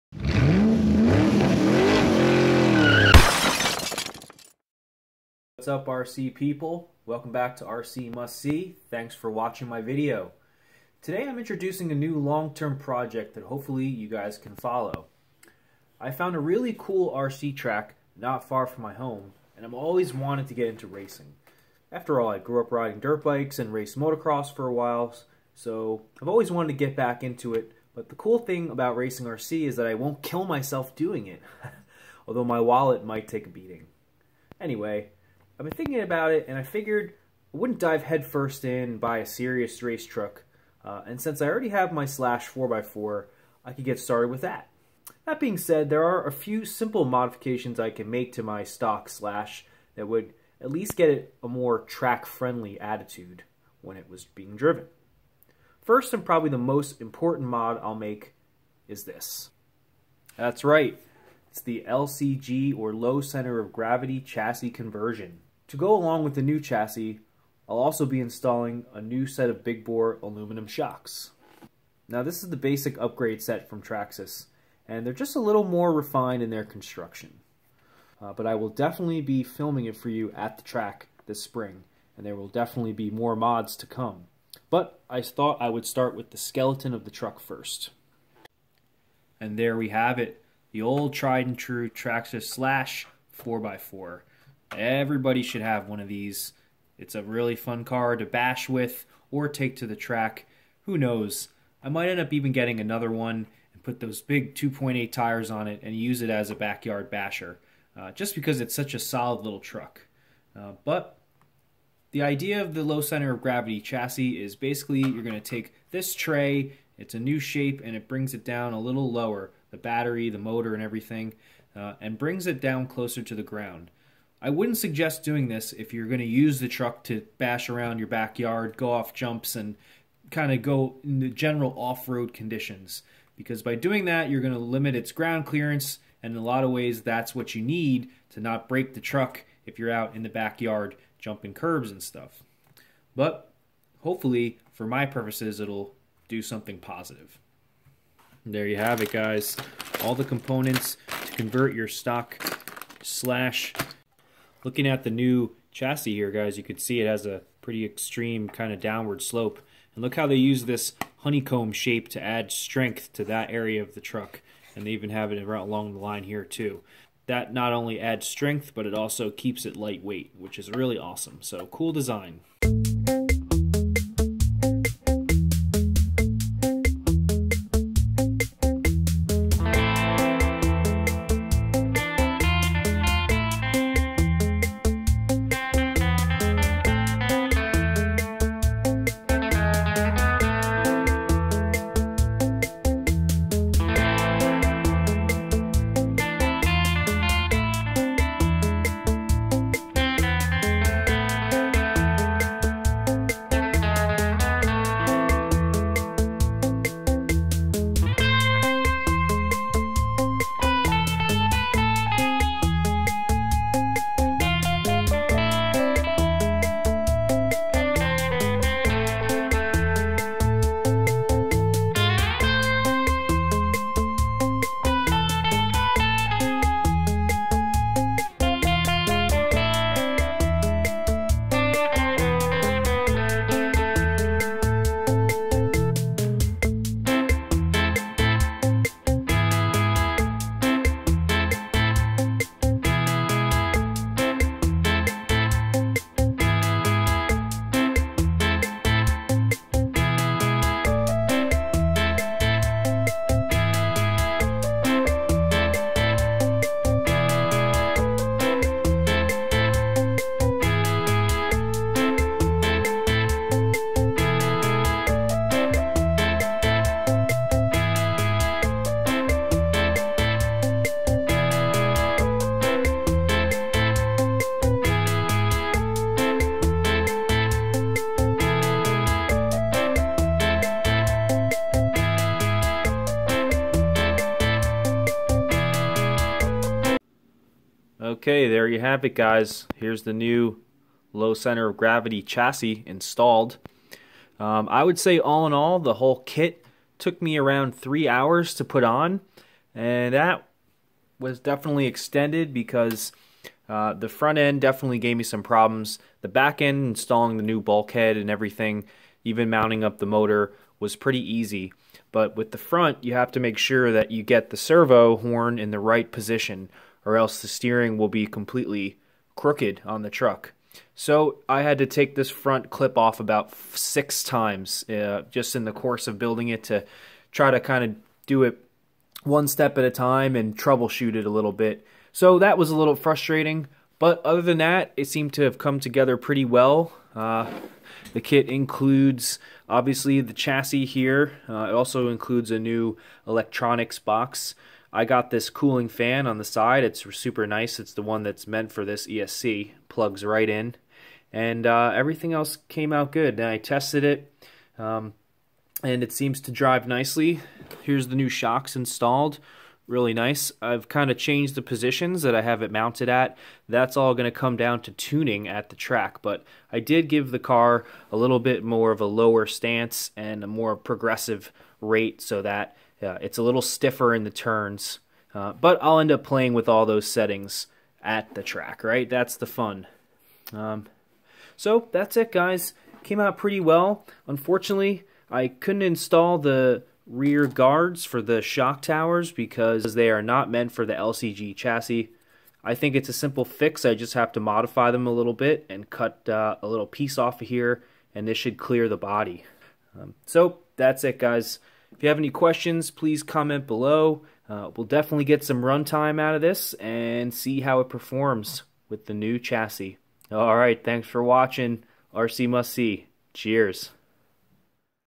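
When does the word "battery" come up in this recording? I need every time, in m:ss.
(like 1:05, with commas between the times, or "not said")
1:59.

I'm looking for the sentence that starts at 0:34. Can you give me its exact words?
Anyway, I've been thinking about it, and I figured I wouldn't dive headfirst in buy a serious race truck.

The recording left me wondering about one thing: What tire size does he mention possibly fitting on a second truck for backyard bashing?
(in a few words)
2.8.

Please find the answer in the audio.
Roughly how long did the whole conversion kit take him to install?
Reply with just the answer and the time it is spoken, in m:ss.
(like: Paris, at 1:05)
3 hours, at 4:57.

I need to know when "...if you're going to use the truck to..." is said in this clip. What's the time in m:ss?
2:05.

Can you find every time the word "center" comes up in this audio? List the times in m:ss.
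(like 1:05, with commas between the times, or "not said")
1:03, 1:53, 4:51.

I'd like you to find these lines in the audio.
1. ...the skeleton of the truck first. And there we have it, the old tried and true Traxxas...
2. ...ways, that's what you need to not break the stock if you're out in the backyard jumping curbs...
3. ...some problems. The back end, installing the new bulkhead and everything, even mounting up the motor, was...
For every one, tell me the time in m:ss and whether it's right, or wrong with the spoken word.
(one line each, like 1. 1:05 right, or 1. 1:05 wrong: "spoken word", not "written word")
1. 1:26 right
2. 2:16 wrong: "truck", not "stock"
3. 5:05 right.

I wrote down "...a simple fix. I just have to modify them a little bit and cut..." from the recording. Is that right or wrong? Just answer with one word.
right.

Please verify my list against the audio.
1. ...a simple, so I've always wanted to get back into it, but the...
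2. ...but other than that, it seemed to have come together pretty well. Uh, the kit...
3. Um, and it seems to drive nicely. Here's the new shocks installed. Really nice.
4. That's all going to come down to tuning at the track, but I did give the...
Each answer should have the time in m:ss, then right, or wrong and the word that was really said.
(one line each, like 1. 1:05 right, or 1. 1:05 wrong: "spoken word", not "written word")
1. 0:24 wrong: "while", not "simple"
2. 5:33 right
3. 5:54 right
4. 6:03 right.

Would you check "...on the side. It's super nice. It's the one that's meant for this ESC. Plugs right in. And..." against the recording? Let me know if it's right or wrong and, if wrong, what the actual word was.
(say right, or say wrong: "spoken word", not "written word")
right.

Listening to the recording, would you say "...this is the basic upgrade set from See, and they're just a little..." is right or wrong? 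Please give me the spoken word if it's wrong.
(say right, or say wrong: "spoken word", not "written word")
wrong: "Traxxas", not "See".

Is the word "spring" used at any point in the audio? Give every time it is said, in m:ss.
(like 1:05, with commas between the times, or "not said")
1:21.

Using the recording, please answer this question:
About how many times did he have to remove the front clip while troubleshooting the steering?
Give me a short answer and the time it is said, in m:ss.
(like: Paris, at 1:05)
6, at 5:23.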